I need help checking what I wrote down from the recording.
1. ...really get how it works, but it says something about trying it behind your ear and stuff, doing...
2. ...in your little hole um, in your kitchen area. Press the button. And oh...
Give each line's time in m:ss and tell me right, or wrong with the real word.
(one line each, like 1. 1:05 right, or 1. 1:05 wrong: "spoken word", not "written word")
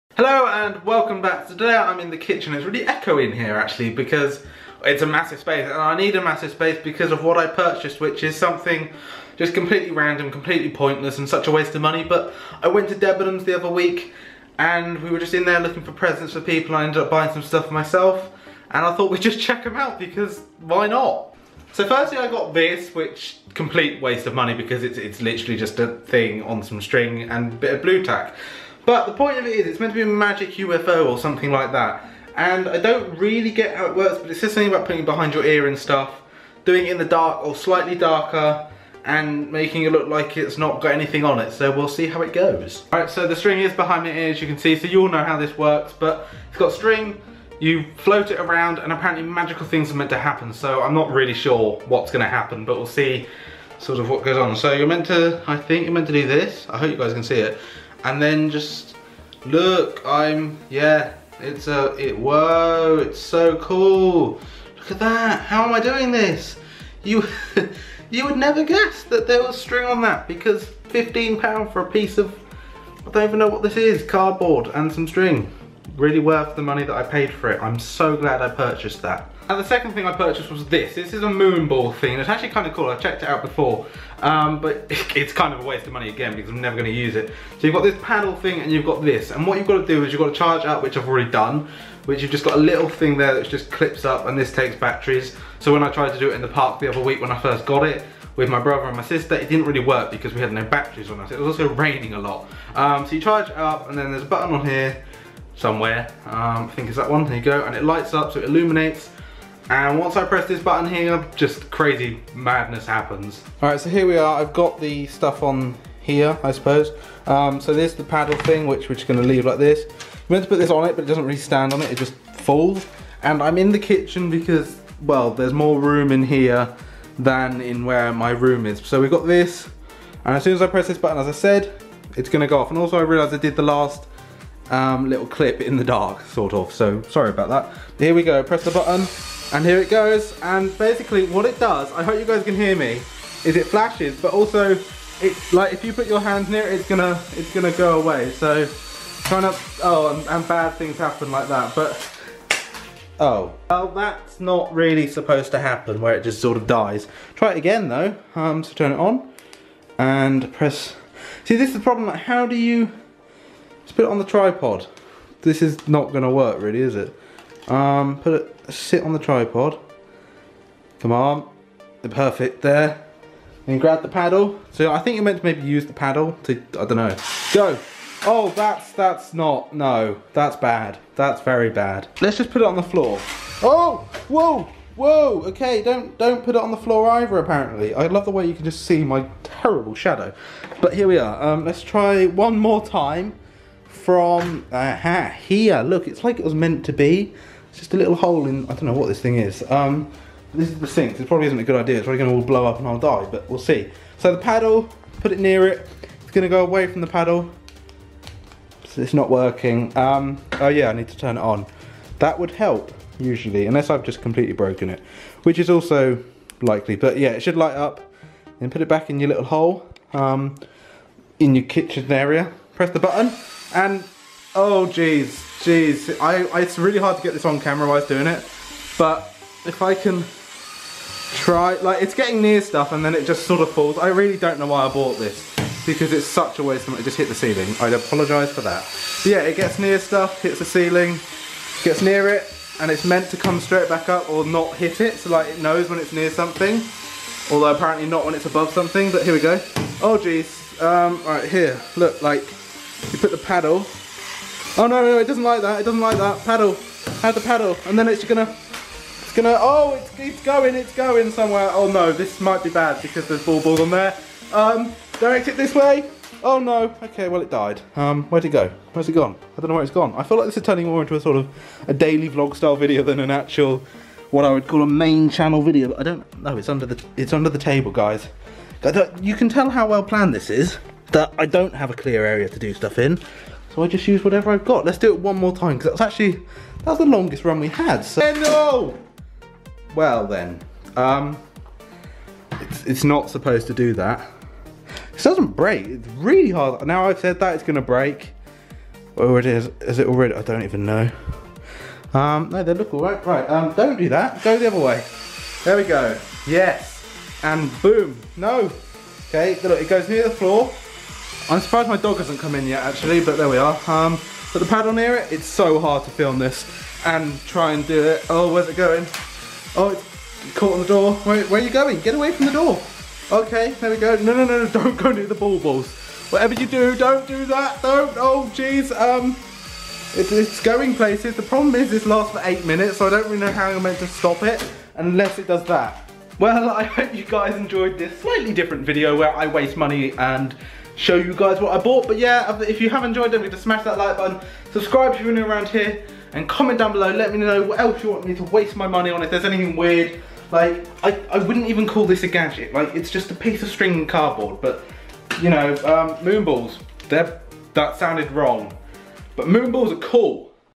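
1. 0:33 wrong: "putting", not "trying"
2. 3:39 right.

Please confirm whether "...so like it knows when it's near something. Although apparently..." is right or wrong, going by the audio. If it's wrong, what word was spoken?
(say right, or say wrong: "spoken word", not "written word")
right.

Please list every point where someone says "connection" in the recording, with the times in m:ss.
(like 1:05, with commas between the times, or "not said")
not said.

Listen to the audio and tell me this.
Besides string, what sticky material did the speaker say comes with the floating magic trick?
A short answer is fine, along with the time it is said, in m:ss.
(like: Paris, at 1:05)
Blu Tack, at 0:27.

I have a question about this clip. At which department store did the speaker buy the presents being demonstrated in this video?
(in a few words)
Debenhams.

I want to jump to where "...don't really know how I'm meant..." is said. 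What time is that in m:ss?
5:33.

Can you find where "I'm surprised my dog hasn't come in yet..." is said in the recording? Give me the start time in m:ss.
5:11.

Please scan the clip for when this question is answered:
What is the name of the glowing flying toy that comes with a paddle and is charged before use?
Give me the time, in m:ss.
1:21.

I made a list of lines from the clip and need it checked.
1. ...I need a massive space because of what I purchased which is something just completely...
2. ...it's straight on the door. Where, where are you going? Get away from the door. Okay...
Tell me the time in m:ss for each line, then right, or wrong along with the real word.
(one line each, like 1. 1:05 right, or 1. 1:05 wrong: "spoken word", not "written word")
1. 0:05 right
2. 5:19 wrong: "caught", not "straight".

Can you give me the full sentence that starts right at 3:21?
It's probably going to all blow up and I'll die, but we'll see.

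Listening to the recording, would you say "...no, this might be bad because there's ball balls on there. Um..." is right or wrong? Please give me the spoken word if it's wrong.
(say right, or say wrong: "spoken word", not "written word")
right.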